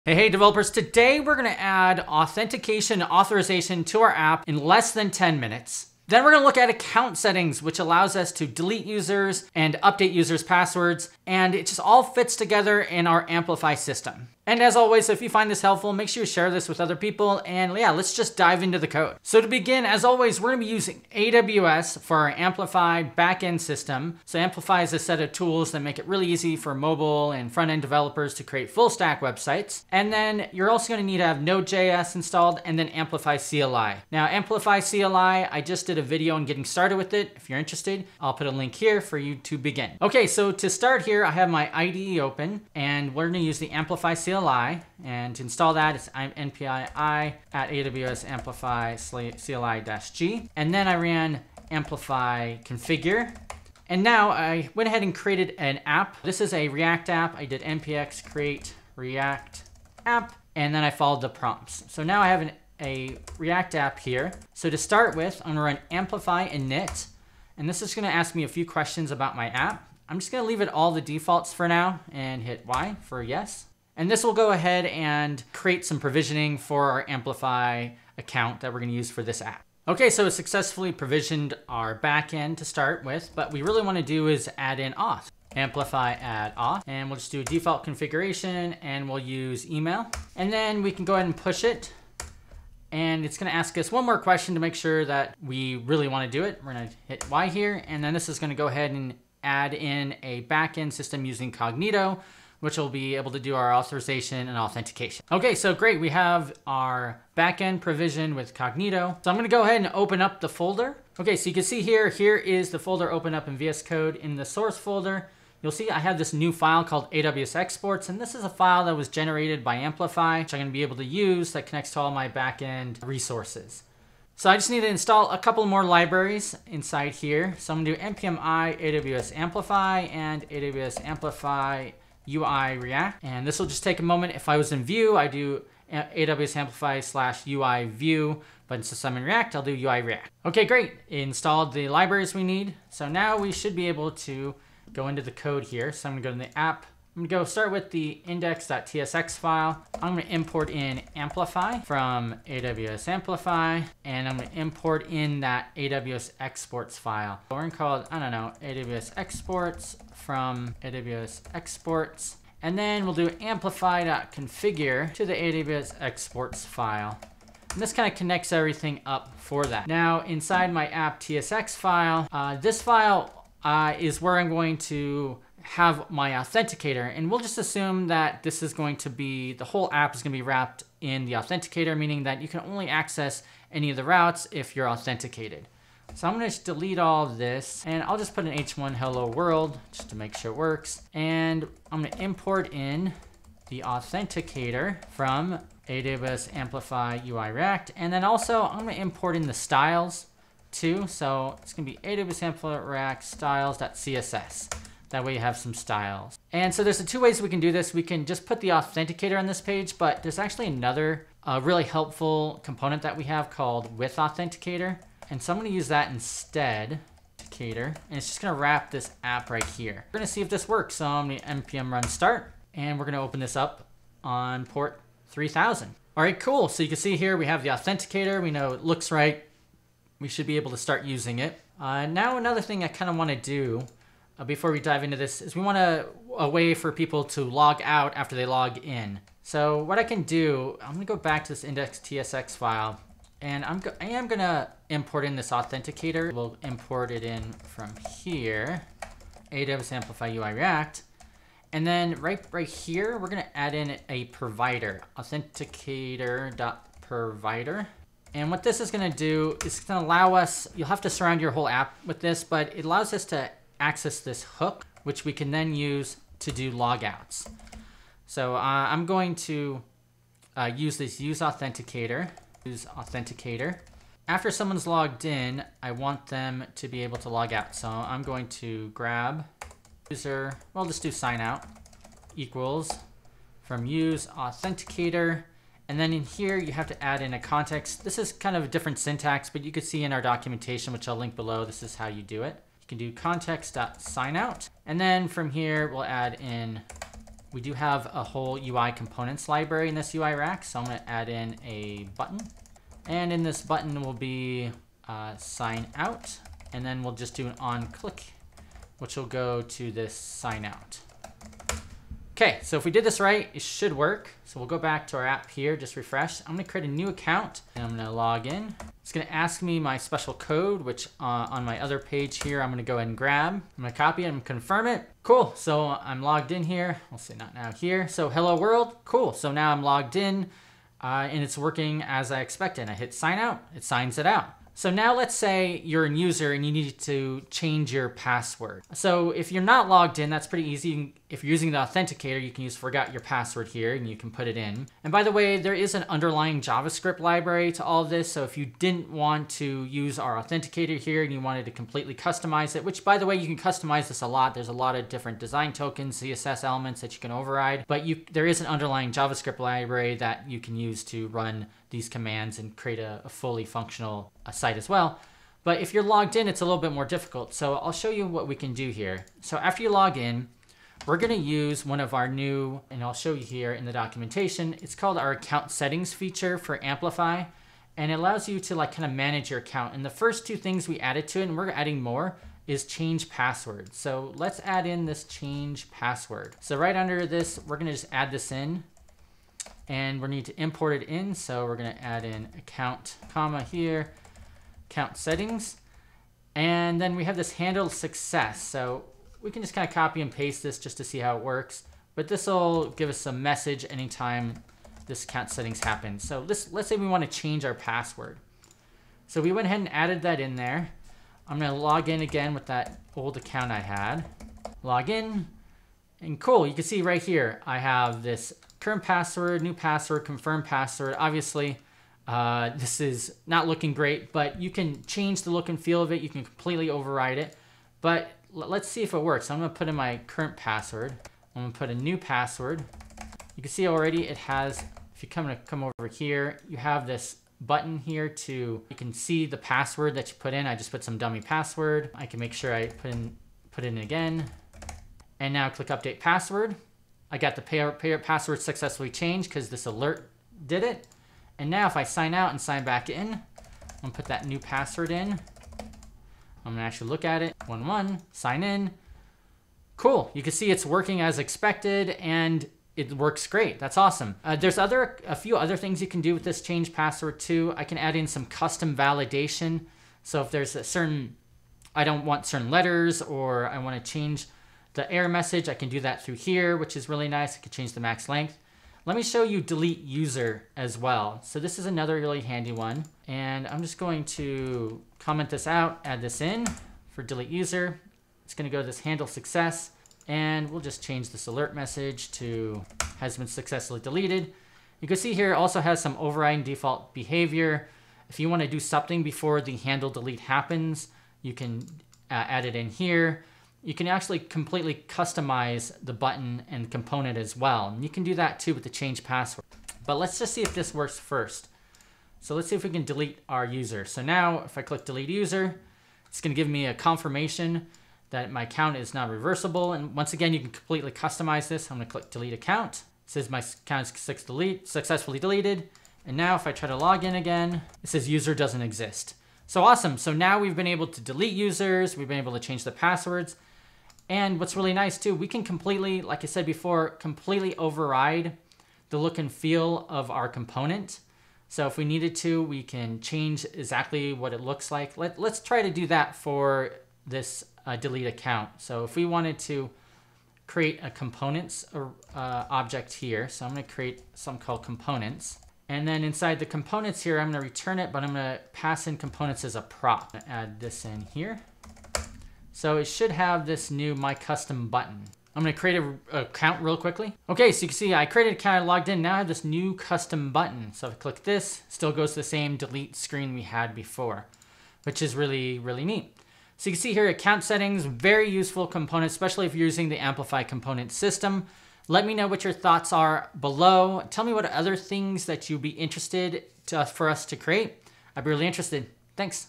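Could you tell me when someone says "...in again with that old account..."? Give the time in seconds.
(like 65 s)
412 s.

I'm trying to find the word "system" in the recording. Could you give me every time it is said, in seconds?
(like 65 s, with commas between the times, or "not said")
13 s, 23 s, 100 s, 581 s.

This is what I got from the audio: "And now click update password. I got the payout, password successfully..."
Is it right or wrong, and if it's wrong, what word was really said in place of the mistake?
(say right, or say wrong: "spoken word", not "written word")
right.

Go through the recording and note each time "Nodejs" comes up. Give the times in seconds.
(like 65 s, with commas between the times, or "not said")
31 s.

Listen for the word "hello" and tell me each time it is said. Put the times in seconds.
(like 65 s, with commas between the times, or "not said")
188 s, 328 s.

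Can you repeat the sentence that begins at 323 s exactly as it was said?
I'm gonna copy and confirm it.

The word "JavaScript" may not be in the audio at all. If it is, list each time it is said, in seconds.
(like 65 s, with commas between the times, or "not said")
346 s, 359 s.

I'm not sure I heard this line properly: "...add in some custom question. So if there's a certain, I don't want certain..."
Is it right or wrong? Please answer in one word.
wrong.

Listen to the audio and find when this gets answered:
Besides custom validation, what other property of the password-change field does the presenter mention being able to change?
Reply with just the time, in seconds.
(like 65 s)
478 s.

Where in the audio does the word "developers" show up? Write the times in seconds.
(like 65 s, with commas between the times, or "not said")
0 s, 27 s.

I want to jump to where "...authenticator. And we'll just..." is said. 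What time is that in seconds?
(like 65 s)
176 s.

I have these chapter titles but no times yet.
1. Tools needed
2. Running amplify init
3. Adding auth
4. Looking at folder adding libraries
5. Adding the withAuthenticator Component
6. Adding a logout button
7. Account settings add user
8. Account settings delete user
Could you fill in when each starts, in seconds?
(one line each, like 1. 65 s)
1. 20 s
2. 65 s
3. 85 s
4. 111 s
5. 146 s
6. 236 s
7. 330 s
8. 479 s.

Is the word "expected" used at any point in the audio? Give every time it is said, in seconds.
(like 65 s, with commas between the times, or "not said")
332 s, 461 s.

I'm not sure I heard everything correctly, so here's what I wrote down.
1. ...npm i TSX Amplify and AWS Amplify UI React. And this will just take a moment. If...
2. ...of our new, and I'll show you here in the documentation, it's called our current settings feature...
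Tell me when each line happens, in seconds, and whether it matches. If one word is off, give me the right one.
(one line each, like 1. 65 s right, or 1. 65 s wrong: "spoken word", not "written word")
1. 128 s wrong: "AWS", not "TSX"
2. 371 s wrong: "account", not "current".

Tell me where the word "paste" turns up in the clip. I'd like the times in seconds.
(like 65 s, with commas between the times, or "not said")
400 s.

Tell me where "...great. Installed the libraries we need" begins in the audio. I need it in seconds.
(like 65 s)
140 s.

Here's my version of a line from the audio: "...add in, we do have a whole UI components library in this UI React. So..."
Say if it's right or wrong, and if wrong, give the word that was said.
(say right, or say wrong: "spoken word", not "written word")
right.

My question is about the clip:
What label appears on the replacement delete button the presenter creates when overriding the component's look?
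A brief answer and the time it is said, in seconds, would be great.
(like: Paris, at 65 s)
My Custom button, at 564 s.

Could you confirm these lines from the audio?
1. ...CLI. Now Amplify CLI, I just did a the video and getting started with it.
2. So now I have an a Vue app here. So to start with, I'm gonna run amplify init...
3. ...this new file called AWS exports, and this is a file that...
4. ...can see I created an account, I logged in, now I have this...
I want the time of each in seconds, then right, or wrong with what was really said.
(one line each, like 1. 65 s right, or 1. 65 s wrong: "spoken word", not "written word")
1. 33 s right
2. 61 s wrong: "React", not "Vue"
3. 116 s right
4. 567 s right.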